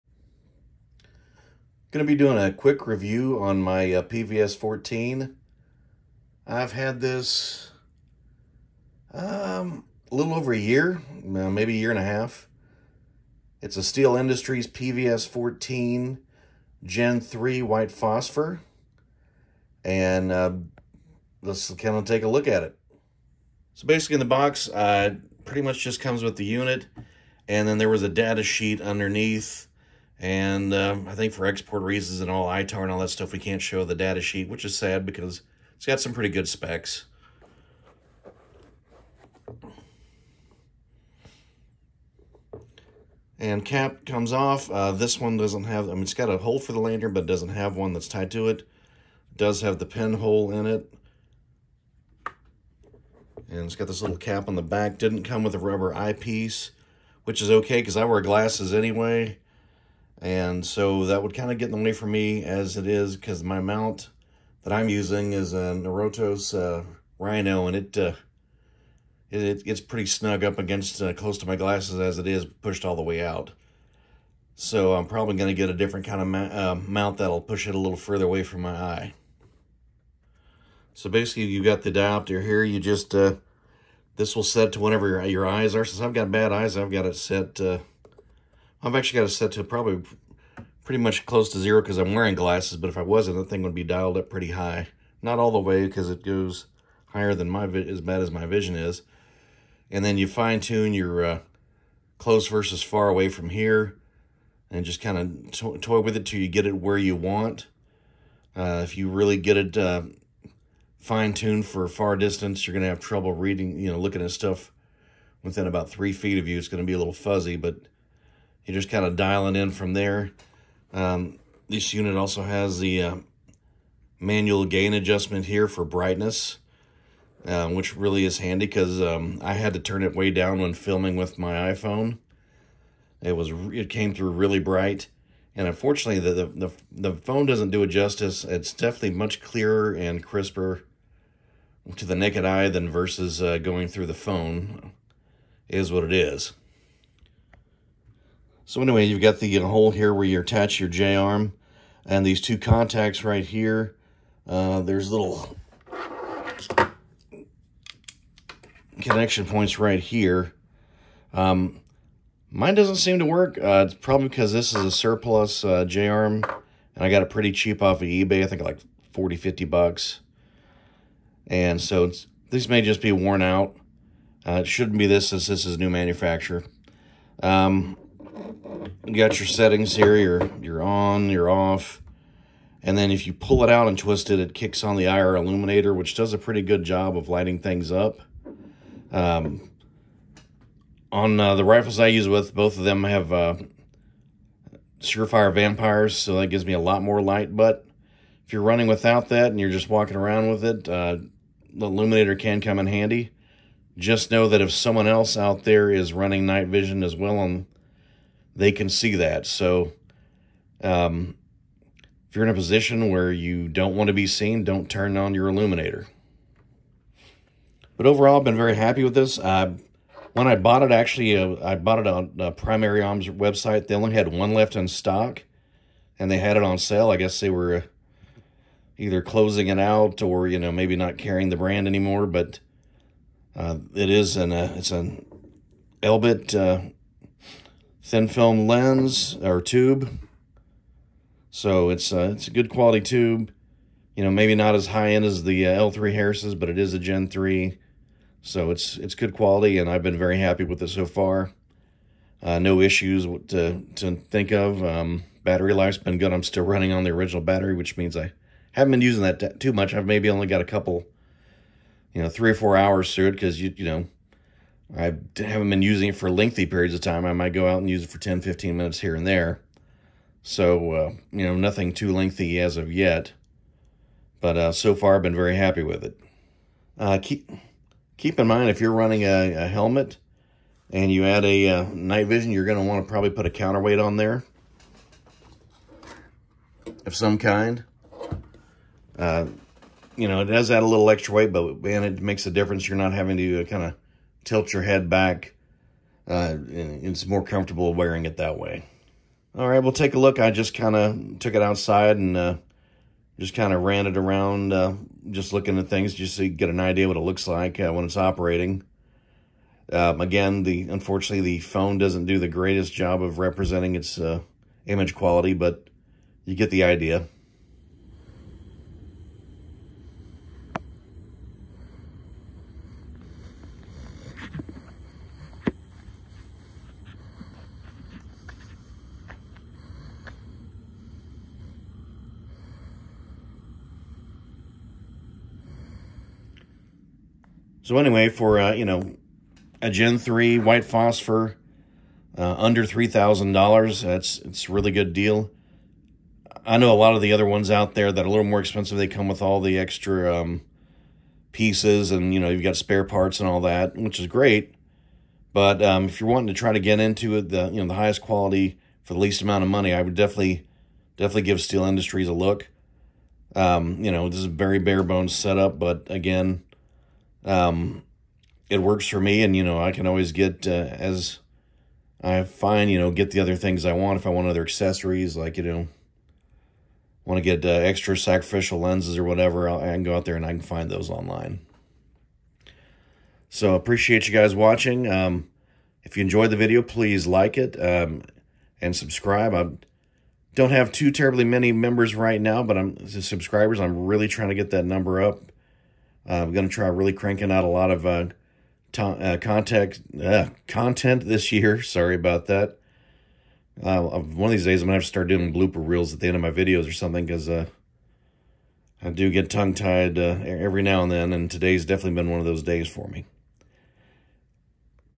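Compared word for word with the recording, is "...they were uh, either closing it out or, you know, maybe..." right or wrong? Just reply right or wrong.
right.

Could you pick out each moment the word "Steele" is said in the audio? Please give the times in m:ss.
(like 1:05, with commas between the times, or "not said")
0:13, 6:01.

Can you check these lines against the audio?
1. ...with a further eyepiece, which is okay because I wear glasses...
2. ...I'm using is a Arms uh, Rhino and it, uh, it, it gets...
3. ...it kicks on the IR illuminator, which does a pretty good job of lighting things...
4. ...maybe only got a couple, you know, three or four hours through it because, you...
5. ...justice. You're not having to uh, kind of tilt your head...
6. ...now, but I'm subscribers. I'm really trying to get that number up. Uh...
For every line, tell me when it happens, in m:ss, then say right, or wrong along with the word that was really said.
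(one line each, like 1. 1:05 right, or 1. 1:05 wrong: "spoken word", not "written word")
1. 0:55 wrong: "rubber", not "further"
2. 1:04 wrong: "Norotos", not "Arms"
3. 3:04 right
4. 4:20 right
5. 4:52 wrong: "difference", not "justice"
6. 6:32 right.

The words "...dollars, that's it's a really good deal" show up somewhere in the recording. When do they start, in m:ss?
5:43.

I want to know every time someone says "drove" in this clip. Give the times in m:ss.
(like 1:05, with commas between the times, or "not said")
not said.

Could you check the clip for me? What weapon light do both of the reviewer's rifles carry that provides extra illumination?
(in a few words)
Surefire Vampires.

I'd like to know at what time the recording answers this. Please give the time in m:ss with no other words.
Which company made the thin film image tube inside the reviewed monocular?
3:56.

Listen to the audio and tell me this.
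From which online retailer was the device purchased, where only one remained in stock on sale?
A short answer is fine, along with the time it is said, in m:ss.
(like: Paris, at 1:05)
Primary Arms, at 3:42.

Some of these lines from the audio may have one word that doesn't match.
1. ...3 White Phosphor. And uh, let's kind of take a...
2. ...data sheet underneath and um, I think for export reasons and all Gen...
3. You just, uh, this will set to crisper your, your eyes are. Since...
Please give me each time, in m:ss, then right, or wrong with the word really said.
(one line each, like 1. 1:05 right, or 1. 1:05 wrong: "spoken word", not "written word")
1. 0:17 right
2. 0:28 wrong: "ITAR", not "Gen"
3. 1:22 wrong: "whenever", not "crisper".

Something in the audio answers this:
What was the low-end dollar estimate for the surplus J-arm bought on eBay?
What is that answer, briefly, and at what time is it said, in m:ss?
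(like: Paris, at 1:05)
40, at 2:49.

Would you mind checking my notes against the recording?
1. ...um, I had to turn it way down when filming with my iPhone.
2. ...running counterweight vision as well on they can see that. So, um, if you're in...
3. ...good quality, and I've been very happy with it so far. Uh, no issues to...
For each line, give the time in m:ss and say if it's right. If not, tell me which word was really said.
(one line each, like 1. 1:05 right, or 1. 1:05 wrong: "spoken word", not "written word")
1. 2:09 right
2. 3:26 wrong: "night", not "counterweight"
3. 4:09 right.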